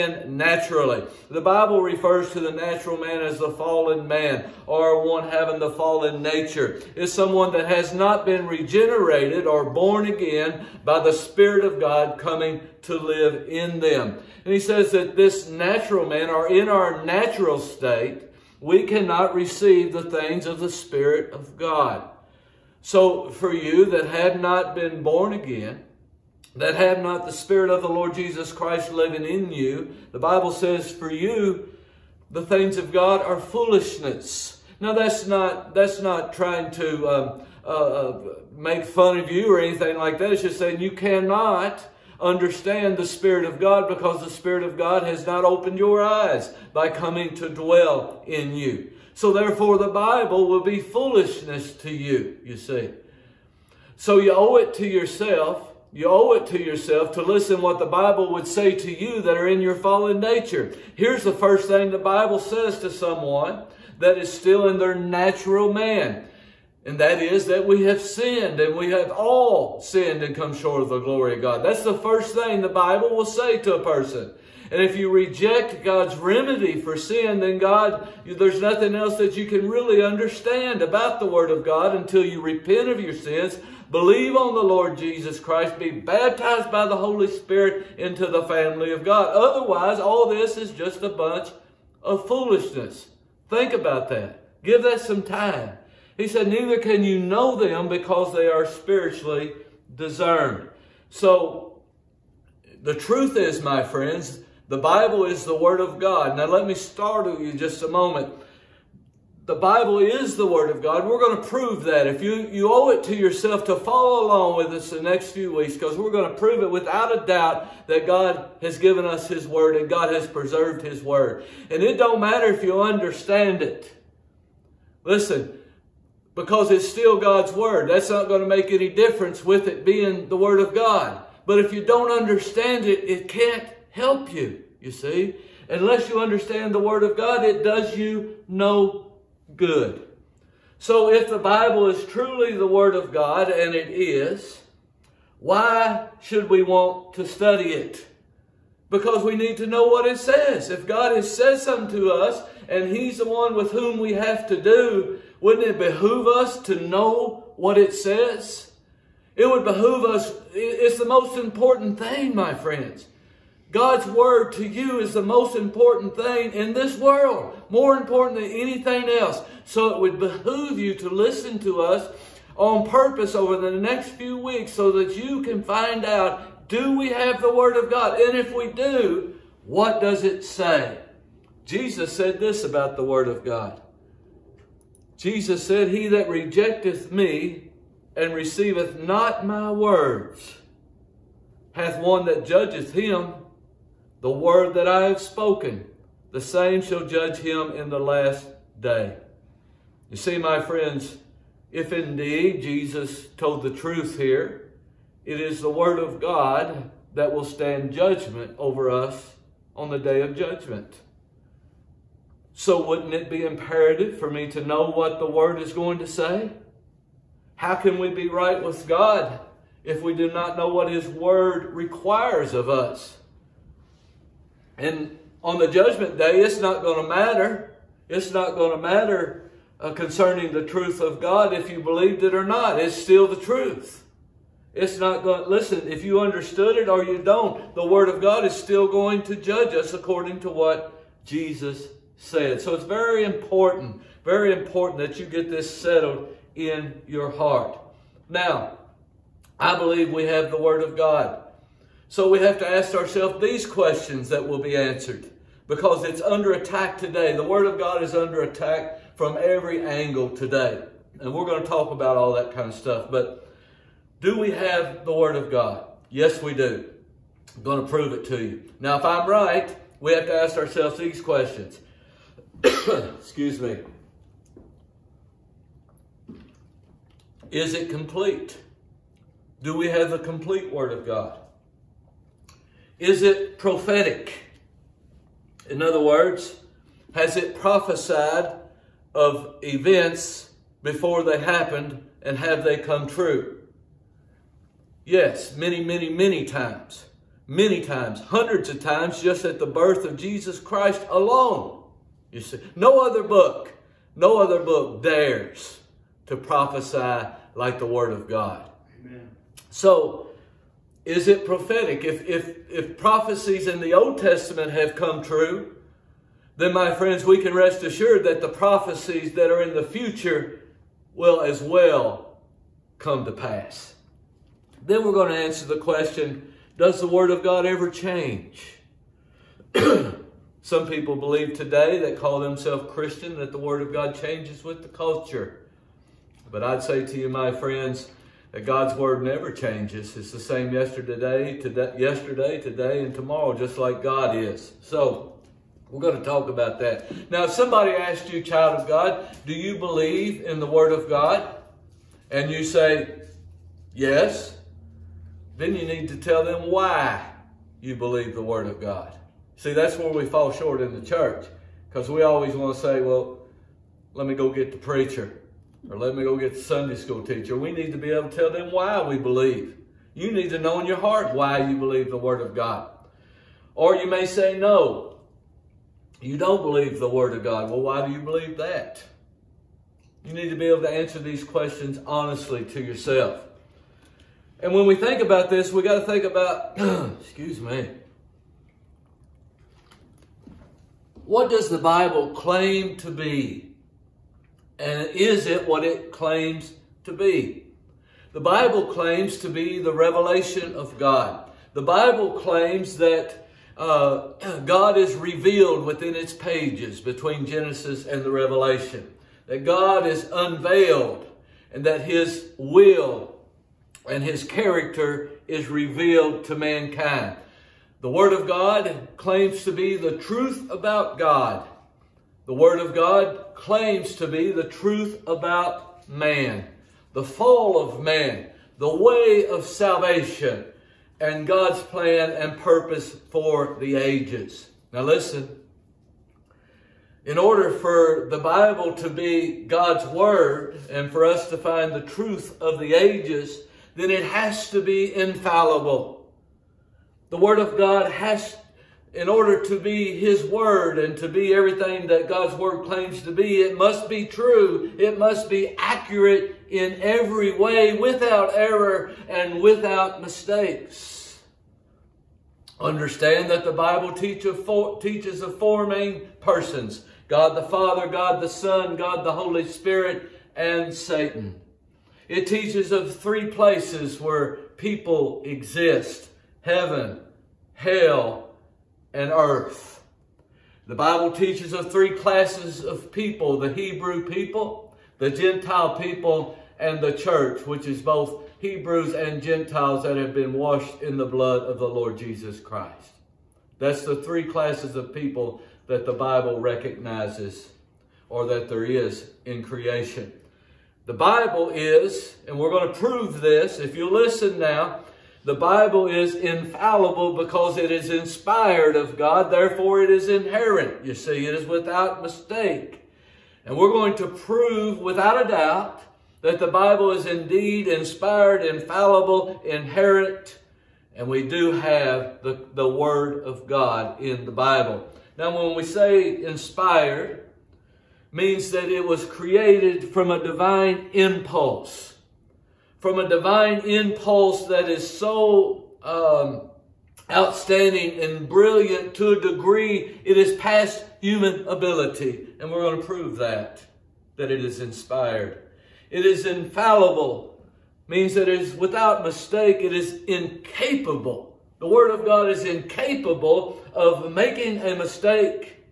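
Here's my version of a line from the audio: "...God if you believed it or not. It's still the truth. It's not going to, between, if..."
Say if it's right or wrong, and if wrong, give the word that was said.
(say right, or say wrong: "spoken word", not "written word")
wrong: "listen", not "between".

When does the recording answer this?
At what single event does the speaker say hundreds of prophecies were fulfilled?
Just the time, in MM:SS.
04:59.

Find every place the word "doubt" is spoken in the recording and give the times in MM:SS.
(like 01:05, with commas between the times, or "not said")
01:57, 08:35.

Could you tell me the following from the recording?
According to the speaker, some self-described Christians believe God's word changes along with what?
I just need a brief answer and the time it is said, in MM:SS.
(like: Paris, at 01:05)
The culture, at 05:34.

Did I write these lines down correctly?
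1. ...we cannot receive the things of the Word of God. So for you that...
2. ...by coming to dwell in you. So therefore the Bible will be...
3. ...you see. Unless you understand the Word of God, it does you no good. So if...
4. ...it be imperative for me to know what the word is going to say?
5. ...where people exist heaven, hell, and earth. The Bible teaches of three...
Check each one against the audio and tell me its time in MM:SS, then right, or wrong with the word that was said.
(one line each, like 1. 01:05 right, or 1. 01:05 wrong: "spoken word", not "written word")
1. 00:18 wrong: "Spirit", not "Word"
2. 00:46 right
3. 02:14 right
4. 03:33 right
5. 07:54 right.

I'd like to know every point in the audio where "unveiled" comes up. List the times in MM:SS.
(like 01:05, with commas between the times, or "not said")
06:50.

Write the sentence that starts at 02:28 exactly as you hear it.
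Because we need to know what it says.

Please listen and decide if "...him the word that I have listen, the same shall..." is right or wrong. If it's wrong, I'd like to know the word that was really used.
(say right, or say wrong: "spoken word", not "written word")
wrong: "spoken", not "listen".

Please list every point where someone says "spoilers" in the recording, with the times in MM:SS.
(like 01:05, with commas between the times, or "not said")
not said.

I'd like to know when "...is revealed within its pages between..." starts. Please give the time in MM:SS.
06:44.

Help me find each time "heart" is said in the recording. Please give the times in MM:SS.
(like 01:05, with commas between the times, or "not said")
04:07, 06:10.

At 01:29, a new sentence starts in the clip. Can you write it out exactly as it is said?
Otherwise, all this is just a bunch of foolishness.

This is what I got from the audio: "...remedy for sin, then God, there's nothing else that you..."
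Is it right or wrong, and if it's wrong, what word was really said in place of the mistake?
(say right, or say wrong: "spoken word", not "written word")
right.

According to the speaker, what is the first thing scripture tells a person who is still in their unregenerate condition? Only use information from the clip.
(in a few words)
We have all sinned.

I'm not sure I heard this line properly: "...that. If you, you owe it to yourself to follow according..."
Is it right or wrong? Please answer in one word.
wrong.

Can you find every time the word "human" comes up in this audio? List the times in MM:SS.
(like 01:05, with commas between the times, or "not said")
09:01.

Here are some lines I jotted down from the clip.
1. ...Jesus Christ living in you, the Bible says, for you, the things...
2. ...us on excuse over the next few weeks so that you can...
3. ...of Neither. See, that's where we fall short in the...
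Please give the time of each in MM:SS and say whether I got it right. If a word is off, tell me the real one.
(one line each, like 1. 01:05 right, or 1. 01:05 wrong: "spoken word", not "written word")
1. 00:28 right
2. 02:51 wrong: "purpose", not "excuse"
3. 05:58 wrong: "God", not "Neither".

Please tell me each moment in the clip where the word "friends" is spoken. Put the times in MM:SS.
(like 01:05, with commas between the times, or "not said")
01:43, 02:42, 03:20, 05:16, 05:37.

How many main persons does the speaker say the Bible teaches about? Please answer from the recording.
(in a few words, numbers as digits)
4.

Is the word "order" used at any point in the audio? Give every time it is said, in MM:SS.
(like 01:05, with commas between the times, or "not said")
07:17, 07:29.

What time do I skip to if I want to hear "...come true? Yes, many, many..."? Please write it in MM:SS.
04:52.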